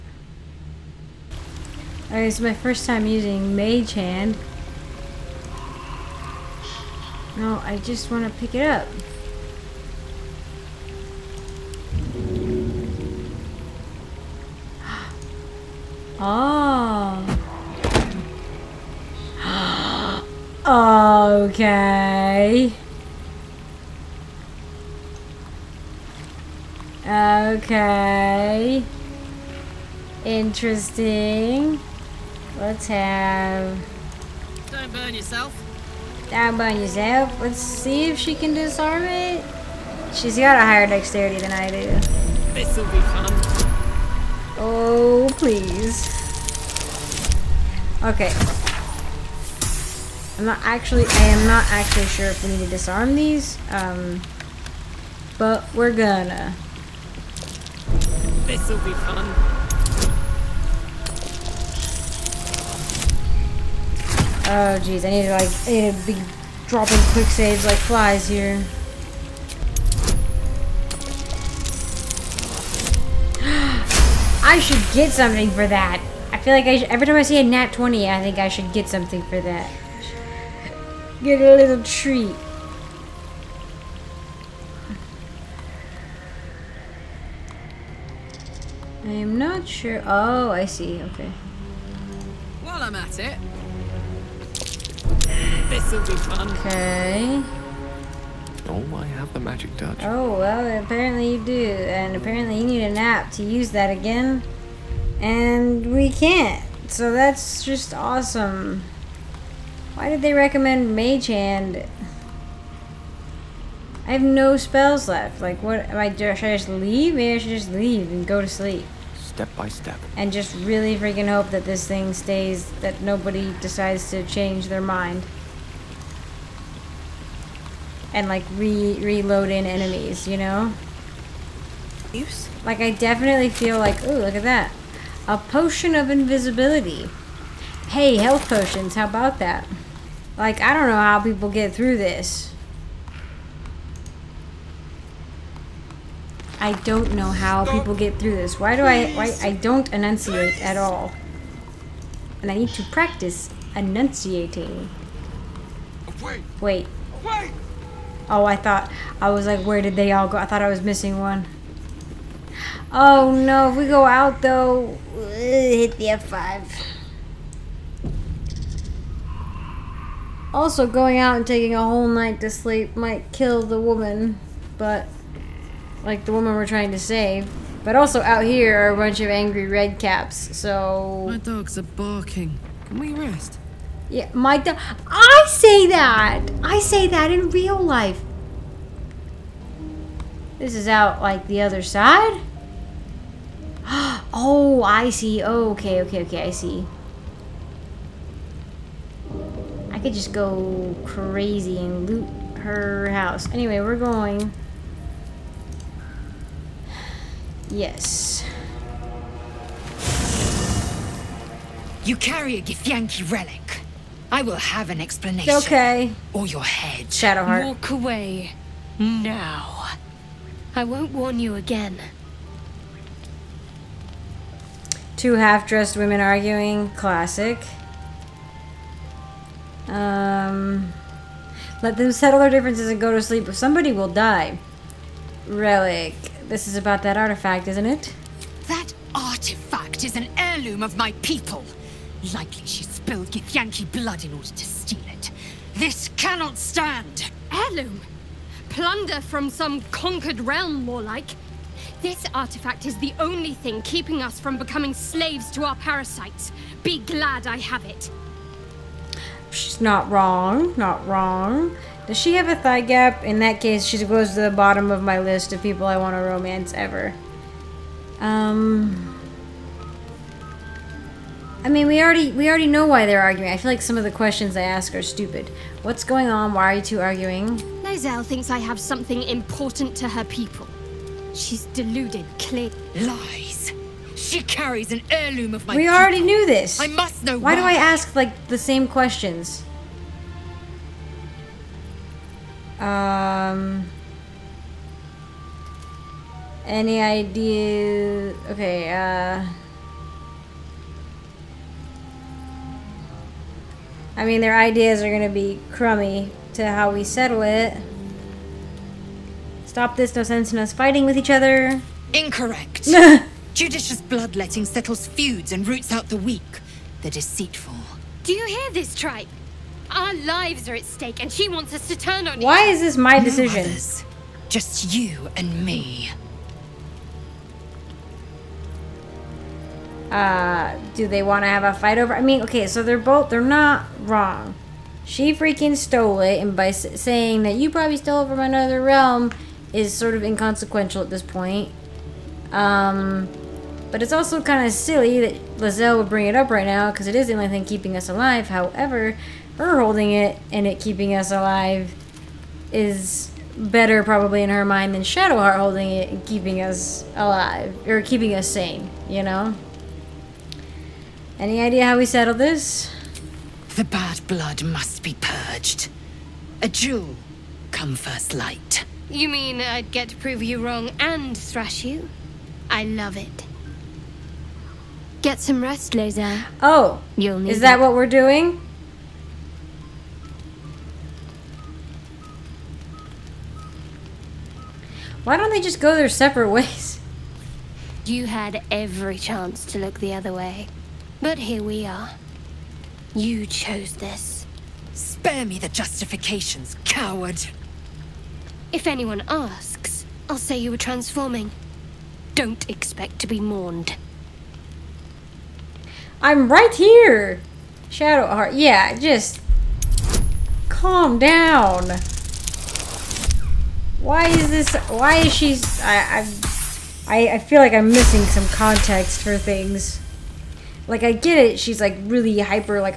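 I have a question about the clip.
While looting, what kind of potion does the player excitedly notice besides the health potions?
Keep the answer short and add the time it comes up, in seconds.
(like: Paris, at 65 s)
Potion of invisibility, at 135 s.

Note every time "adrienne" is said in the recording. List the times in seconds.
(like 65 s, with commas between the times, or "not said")
not said.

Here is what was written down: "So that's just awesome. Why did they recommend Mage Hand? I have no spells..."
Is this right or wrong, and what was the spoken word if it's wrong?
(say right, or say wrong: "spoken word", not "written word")
right.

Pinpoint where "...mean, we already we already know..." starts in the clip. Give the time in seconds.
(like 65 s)
271 s.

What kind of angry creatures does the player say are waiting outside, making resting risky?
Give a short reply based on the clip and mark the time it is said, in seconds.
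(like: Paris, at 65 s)
Red caps, at 179 s.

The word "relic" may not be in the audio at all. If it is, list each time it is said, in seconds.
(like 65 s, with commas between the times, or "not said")
213 s, 235 s.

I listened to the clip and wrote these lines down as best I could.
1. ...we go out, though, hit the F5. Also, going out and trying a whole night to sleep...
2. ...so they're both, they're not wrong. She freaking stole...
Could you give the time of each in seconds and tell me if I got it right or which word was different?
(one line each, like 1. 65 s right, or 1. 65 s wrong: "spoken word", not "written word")
1. 163 s wrong: "taking", not "trying"
2. 332 s right.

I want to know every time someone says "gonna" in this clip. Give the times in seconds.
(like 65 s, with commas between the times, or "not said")
55 s, 305 s.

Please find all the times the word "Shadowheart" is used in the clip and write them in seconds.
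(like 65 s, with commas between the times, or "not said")
217 s, 355 s, 407 s.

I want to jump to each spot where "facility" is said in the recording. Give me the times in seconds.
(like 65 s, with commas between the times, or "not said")
not said.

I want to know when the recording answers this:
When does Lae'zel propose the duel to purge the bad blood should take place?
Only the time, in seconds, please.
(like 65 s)
367 s.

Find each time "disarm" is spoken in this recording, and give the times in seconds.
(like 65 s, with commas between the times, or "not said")
38 s, 52 s.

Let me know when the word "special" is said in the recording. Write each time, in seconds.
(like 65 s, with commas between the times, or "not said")
not said.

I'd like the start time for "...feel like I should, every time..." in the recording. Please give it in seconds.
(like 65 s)
76 s.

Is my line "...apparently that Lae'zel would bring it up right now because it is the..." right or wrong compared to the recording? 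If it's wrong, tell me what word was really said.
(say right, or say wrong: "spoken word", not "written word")
wrong: "silly", not "apparently".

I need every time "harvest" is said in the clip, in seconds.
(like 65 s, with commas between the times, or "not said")
not said.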